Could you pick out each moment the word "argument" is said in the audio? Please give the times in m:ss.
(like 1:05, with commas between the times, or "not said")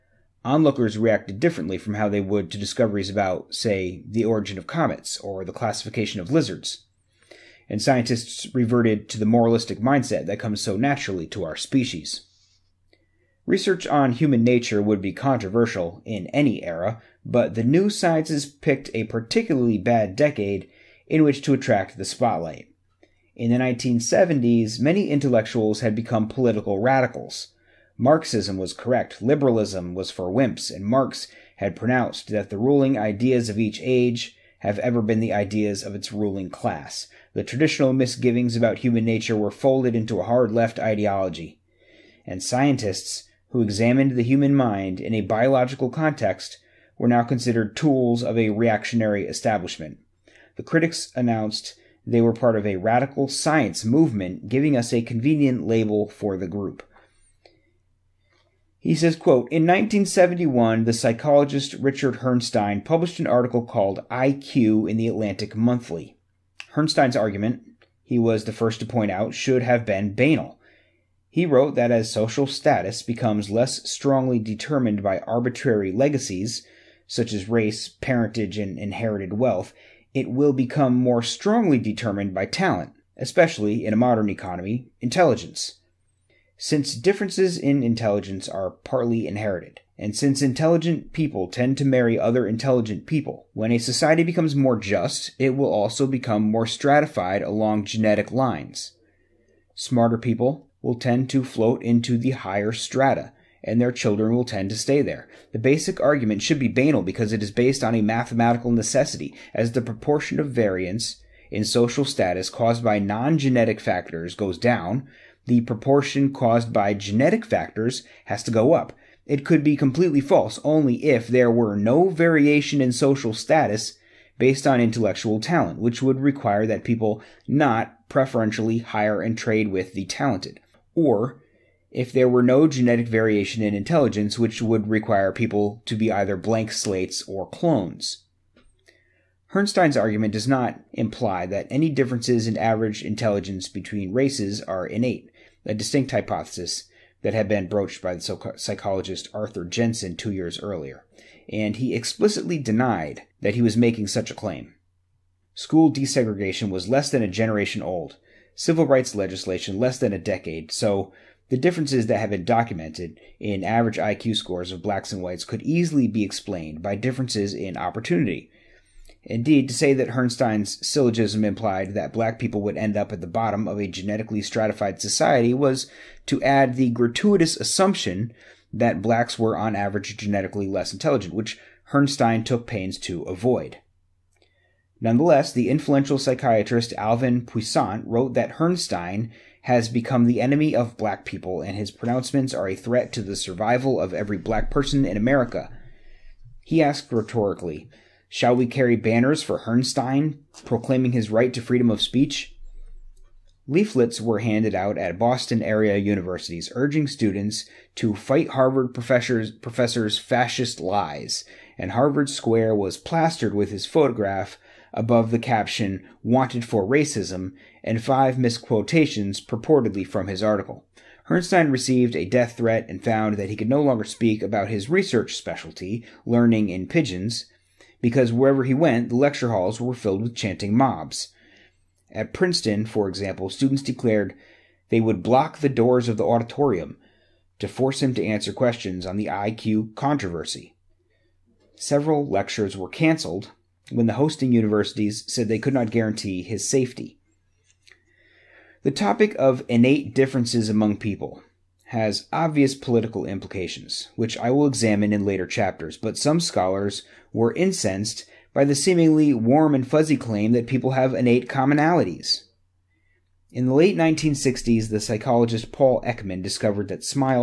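1:07, 1:46, 2:19.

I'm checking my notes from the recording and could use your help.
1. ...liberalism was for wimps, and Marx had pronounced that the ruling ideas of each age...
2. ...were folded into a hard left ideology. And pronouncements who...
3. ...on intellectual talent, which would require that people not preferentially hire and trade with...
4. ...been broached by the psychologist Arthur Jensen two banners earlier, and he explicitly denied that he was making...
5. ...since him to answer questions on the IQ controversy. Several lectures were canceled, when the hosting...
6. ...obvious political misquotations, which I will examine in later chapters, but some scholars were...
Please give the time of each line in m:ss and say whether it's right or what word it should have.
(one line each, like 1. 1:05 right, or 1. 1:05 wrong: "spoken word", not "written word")
1. 0:29 right
2. 0:39 wrong: "scientists", not "pronouncements"
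3. 2:04 right
4. 2:27 wrong: "years", not "banners"
5. 3:57 wrong: "force", not "since"
6. 4:12 wrong: "implications", not "misquotations".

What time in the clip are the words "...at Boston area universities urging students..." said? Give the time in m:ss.
3:24.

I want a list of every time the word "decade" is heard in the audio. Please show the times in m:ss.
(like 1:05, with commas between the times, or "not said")
0:20, 2:40.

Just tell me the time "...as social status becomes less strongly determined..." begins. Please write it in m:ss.
1:11.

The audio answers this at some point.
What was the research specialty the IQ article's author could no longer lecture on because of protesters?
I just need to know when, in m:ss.
3:46.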